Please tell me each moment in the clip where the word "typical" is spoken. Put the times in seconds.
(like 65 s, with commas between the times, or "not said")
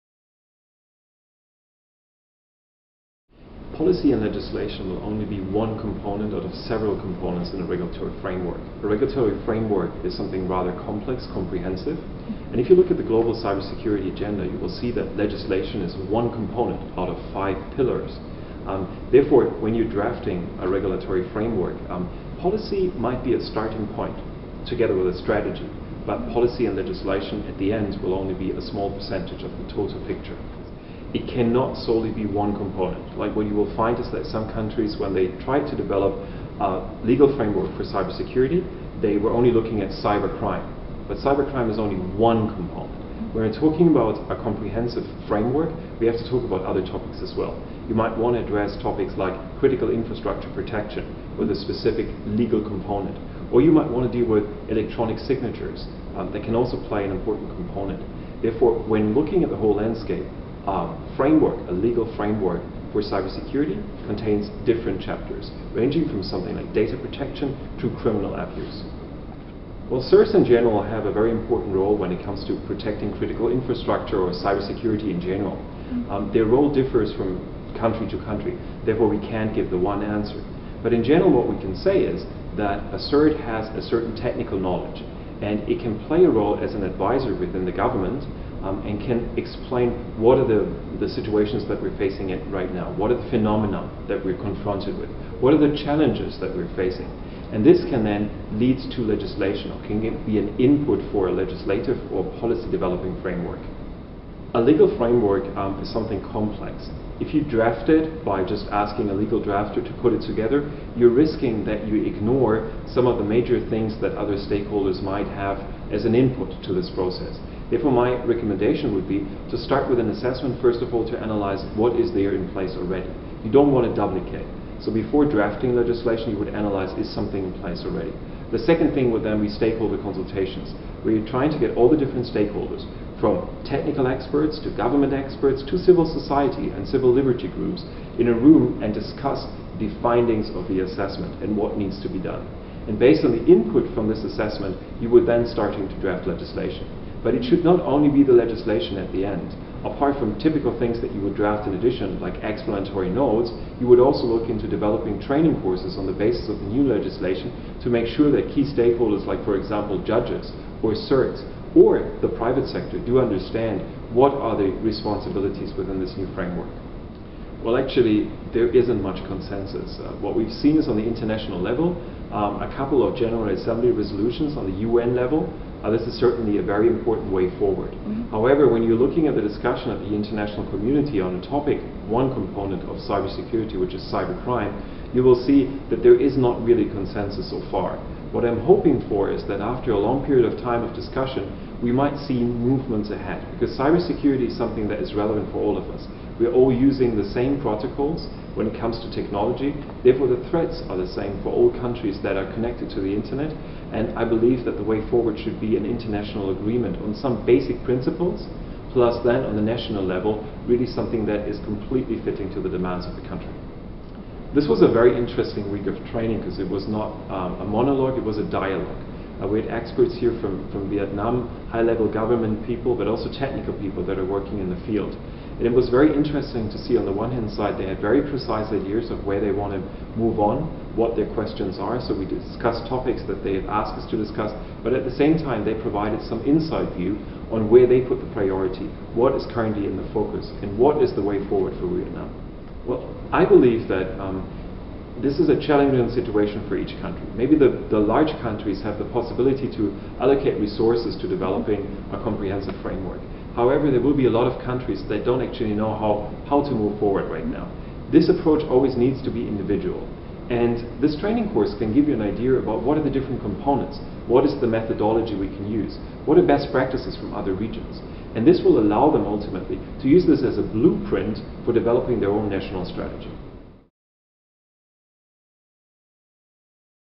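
150 s.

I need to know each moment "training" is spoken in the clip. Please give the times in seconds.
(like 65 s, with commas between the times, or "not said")
155 s, 216 s, 261 s.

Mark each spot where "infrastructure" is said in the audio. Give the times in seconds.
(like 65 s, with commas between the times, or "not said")
49 s, 73 s.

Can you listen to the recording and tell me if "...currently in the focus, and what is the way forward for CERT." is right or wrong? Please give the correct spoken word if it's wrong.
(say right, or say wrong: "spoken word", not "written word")
wrong: "Vietnam", not "CERT".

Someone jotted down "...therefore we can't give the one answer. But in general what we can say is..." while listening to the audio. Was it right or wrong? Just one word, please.
right.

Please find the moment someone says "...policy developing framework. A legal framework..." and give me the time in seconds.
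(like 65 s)
102 s.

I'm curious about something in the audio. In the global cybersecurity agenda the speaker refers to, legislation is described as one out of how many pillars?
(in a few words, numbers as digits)
5.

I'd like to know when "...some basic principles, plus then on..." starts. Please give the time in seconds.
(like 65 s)
207 s.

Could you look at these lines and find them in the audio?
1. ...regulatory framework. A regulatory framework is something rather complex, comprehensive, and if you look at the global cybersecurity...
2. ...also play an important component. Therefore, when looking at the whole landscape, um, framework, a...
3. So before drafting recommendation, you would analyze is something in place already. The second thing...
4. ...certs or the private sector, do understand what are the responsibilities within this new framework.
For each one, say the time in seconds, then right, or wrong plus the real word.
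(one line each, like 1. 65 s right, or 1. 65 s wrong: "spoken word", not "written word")
1. 7 s right
2. 56 s right
3. 124 s wrong: "legislation", not "recommendation"
4. 160 s right.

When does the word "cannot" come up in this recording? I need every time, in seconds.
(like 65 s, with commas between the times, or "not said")
31 s.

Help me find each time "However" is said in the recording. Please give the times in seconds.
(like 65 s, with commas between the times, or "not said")
178 s, 253 s.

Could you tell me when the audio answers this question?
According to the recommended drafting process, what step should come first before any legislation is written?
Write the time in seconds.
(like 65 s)
119 s.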